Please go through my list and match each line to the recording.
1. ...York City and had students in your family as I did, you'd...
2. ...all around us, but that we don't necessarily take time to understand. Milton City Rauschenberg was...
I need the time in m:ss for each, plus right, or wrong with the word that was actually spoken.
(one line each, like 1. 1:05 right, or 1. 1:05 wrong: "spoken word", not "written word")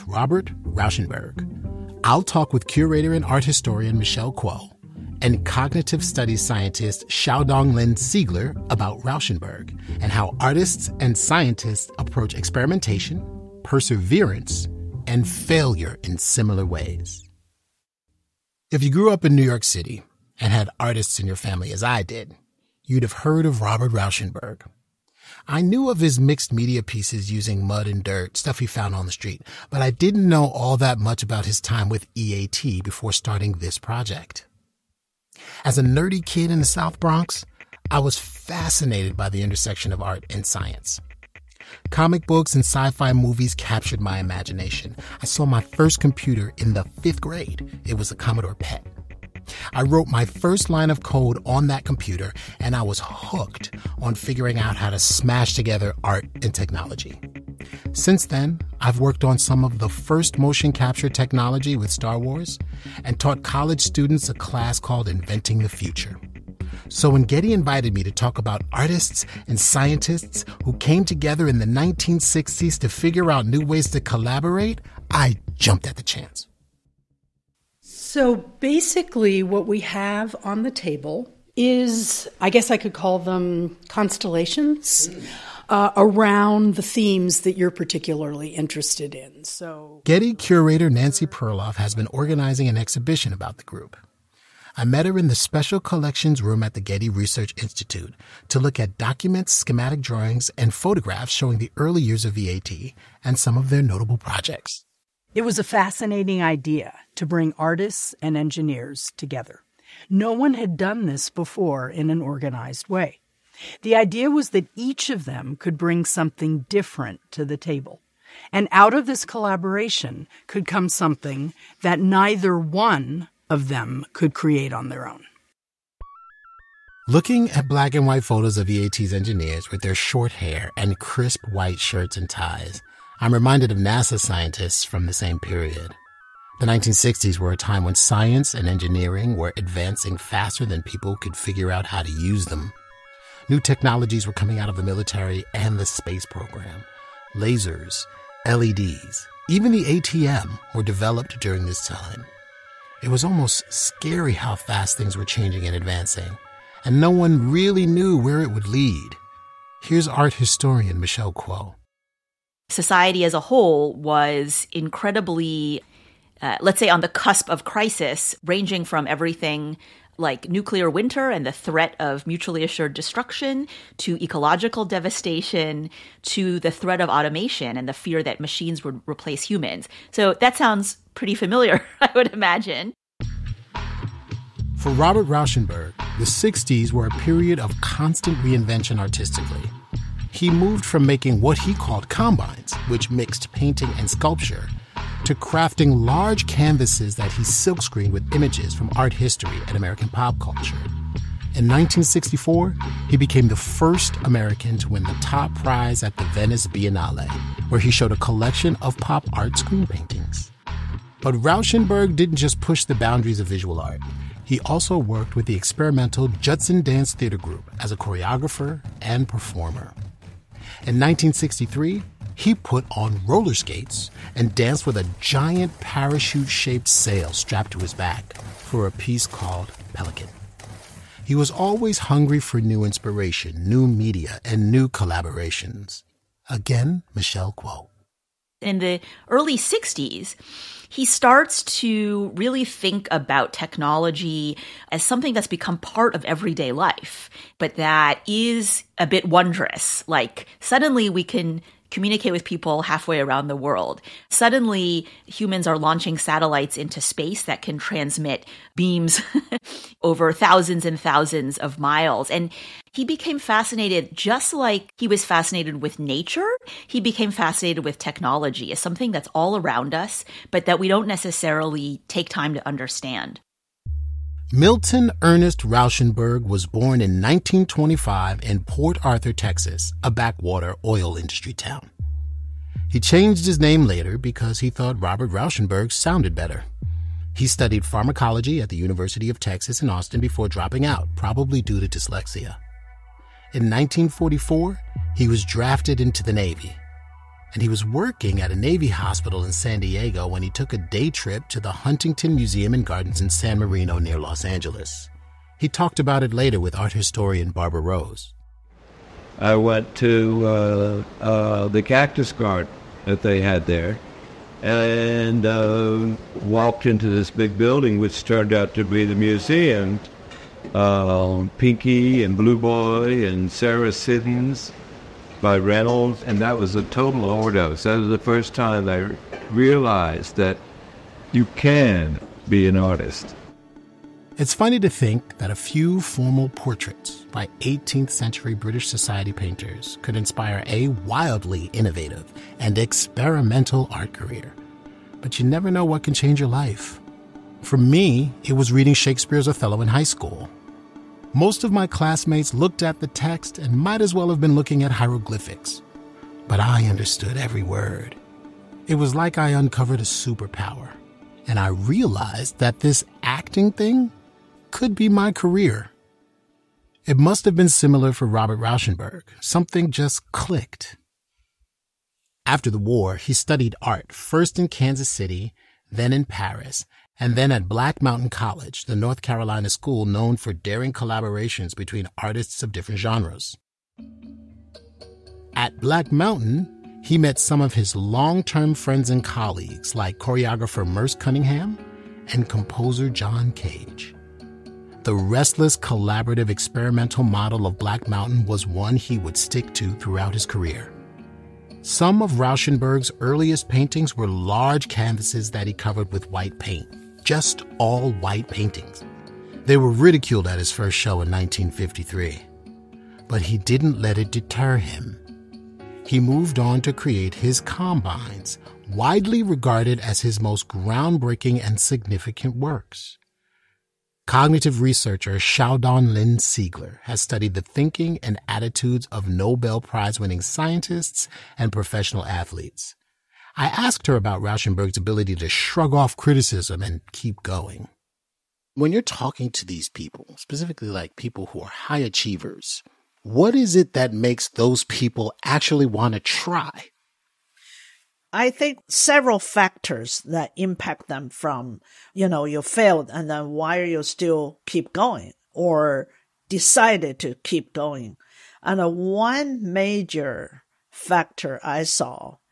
1. 0:19 wrong: "artists", not "students"
2. 4:29 wrong: "Ernest", not "City".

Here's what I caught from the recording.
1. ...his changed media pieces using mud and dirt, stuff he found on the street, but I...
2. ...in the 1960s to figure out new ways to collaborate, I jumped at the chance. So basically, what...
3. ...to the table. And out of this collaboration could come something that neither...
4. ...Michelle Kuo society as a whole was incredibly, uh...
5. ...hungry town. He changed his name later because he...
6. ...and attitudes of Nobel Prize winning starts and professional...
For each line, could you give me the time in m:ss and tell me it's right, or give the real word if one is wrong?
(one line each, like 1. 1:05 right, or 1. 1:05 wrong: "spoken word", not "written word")
1. 0:25 wrong: "mixed", not "changed"
2. 1:11 right
3. 1:57 right
4. 2:41 right
5. 4:41 wrong: "industry", not "hungry"
6. 7:08 wrong: "scientists", not "starts".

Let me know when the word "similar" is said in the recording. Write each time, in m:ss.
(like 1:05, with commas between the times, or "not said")
0:16, 6:07.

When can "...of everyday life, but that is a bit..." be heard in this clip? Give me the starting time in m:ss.
4:06.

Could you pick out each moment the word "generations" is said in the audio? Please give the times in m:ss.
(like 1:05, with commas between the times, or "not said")
not said.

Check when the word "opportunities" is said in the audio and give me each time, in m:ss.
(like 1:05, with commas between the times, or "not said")
not said.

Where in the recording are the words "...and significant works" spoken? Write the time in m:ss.
7:01.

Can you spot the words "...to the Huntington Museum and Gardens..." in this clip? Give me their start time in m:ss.
5:01.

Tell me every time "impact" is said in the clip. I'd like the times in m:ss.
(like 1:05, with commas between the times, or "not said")
7:30.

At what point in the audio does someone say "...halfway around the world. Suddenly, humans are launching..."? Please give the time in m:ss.
4:12.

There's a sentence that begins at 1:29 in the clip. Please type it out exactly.
So, Getty curator Nancy Perloff has been organizing an exhibition about the group.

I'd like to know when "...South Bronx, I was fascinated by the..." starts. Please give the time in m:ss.
0:36.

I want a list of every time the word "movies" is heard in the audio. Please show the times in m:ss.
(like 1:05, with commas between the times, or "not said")
0:43.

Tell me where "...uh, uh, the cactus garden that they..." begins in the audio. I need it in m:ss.
5:10.